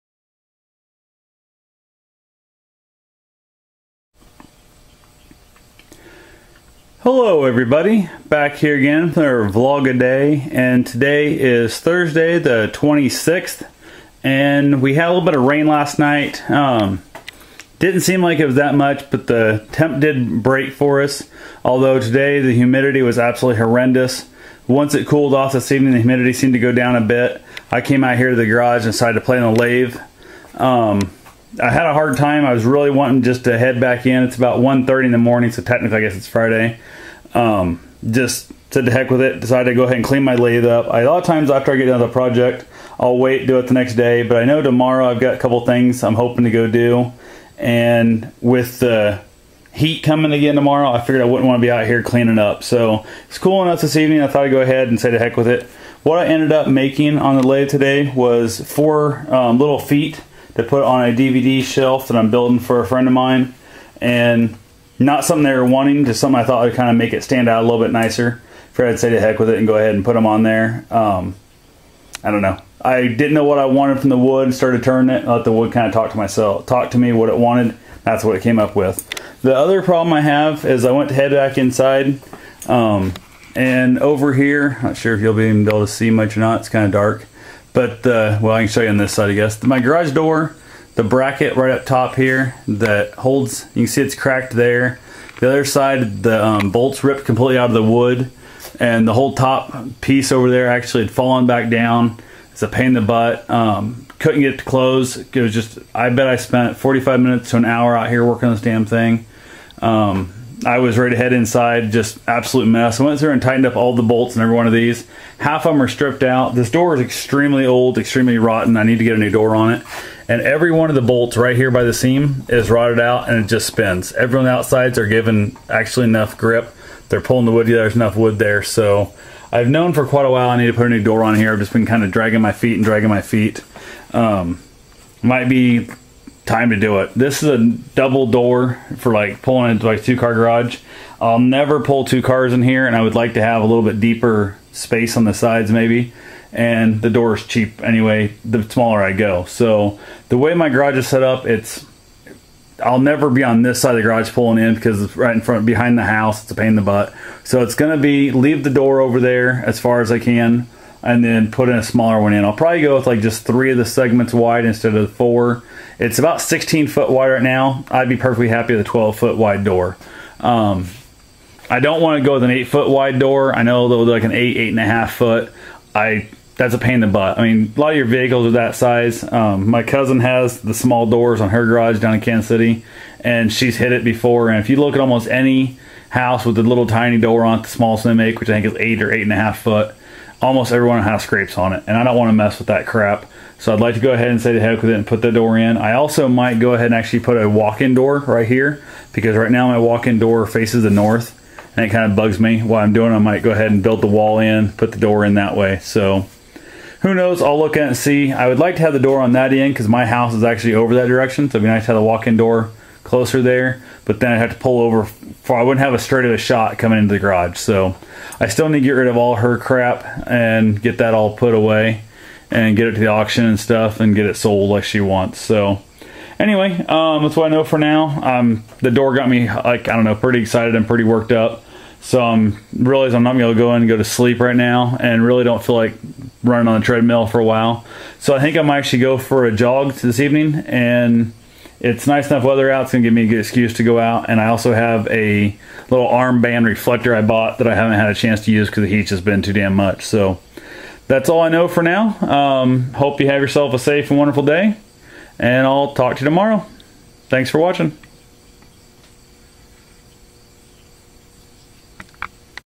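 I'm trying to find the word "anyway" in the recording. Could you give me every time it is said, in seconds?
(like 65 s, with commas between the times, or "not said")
147 s, 226 s.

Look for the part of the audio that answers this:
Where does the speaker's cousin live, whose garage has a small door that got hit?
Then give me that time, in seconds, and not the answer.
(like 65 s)
182 s.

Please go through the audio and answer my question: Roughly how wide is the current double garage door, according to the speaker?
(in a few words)
16 foot.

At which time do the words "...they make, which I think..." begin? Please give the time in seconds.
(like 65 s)
187 s.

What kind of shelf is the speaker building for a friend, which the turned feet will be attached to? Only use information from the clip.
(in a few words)
DVD shelf.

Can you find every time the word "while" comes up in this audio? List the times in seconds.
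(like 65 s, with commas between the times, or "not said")
130 s, 237 s.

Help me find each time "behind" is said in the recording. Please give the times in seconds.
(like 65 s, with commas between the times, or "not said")
155 s.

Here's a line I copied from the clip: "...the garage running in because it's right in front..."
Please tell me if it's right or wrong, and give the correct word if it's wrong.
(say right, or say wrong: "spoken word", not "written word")
wrong: "pulling", not "running".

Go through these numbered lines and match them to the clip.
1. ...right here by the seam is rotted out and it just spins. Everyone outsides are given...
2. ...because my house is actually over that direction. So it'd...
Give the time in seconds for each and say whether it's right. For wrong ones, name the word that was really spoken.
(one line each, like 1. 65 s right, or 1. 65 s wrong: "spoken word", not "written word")
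1. 121 s right
2. 209 s right.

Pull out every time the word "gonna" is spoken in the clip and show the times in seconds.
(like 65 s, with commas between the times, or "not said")
157 s, 233 s, 242 s.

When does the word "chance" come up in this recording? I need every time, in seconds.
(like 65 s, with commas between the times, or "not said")
248 s.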